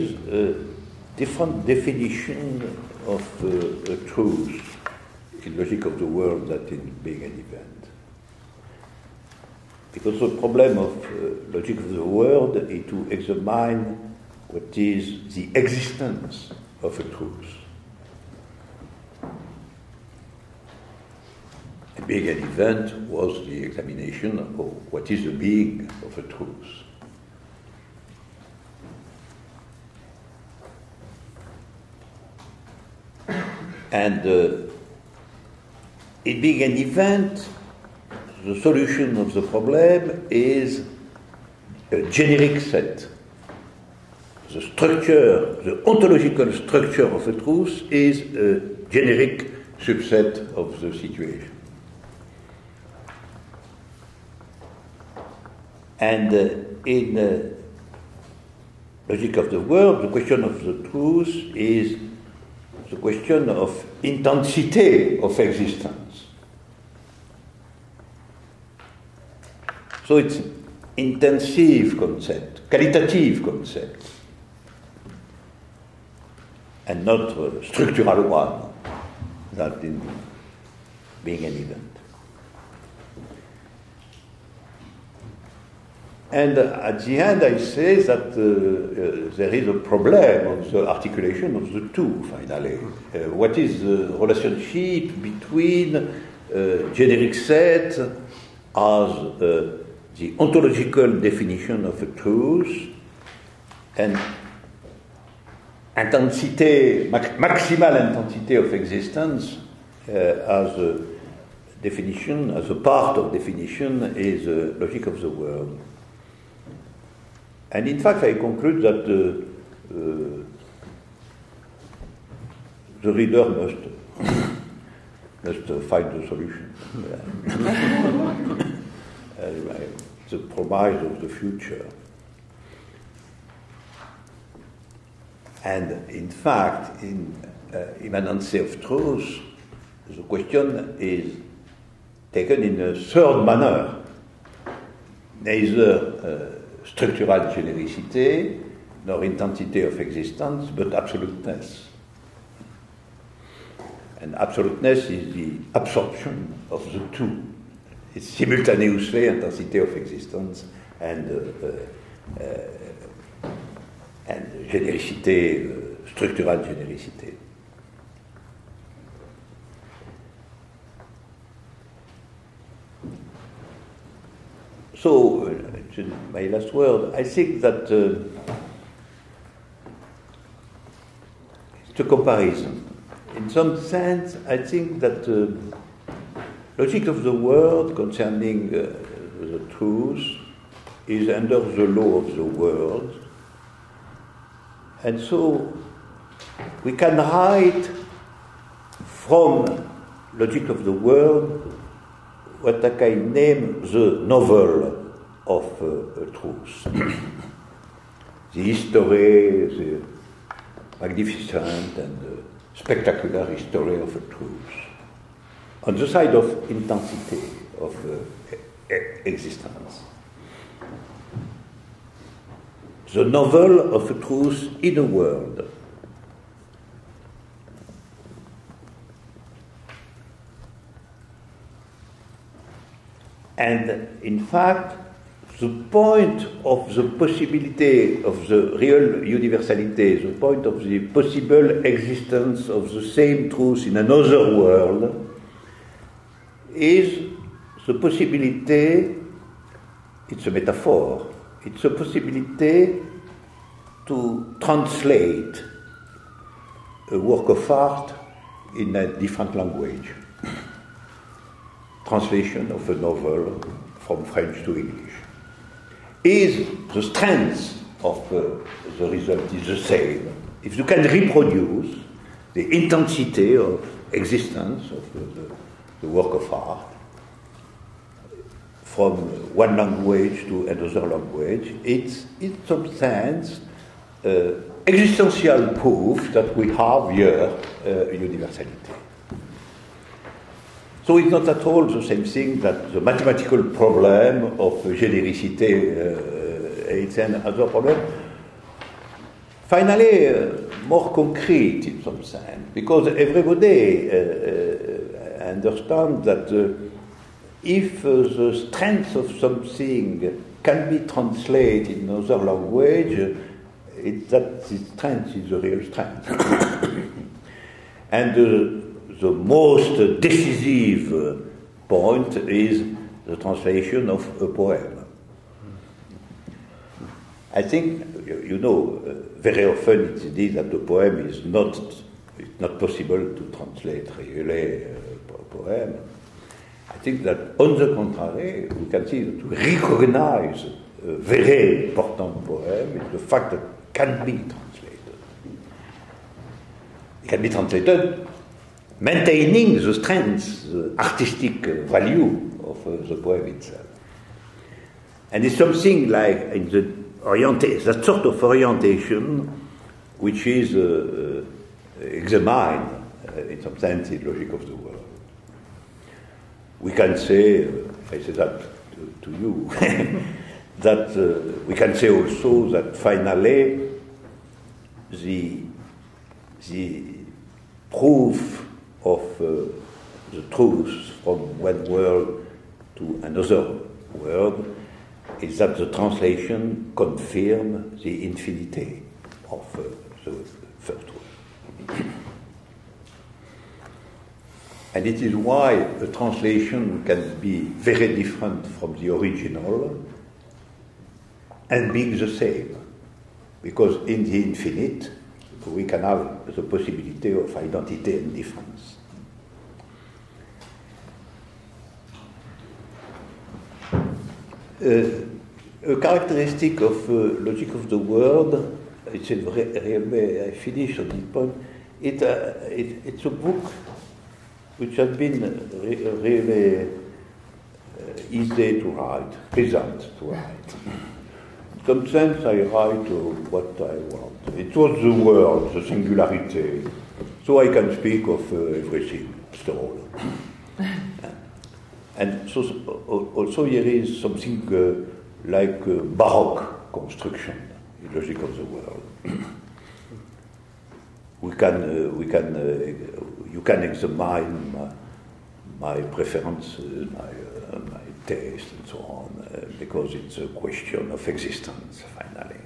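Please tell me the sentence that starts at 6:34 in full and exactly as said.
And it is why a translation can be very different from the original and being the same.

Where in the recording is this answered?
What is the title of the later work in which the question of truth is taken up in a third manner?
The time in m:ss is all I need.
2:18.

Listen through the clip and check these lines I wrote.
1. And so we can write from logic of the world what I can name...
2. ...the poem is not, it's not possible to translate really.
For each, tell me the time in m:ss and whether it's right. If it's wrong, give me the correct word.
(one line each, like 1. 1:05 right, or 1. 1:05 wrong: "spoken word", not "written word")
1. 3:15 right
2. 5:30 right.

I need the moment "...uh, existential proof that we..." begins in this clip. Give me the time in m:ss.
4:44.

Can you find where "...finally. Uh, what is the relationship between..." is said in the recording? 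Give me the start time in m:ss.
1:32.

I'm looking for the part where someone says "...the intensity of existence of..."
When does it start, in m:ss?
4:32.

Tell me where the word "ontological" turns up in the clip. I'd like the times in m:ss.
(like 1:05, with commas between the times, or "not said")
0:45, 1:40.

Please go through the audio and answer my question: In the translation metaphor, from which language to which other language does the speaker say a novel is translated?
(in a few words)
French to English.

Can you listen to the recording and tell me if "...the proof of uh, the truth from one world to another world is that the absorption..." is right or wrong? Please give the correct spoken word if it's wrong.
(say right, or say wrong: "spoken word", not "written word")
wrong: "translation", not "absorption".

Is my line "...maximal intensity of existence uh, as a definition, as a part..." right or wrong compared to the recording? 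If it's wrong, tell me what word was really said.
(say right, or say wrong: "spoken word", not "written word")
right.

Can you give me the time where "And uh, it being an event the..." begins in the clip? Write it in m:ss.
0:33.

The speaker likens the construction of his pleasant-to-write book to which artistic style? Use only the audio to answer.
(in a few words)
Baroque.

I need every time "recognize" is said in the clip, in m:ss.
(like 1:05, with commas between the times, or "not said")
5:39.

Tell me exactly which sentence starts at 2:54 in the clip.
So, uh, my last word, I think that uh, it's a comparison.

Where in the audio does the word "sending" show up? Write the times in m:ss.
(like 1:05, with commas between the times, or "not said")
not said.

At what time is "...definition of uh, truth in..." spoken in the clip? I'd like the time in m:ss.
0:01.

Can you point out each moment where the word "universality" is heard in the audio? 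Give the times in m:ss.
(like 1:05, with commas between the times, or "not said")
3:59, 4:48.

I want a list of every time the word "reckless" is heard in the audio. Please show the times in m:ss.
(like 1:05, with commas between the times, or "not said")
not said.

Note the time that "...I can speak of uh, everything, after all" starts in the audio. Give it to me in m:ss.
7:17.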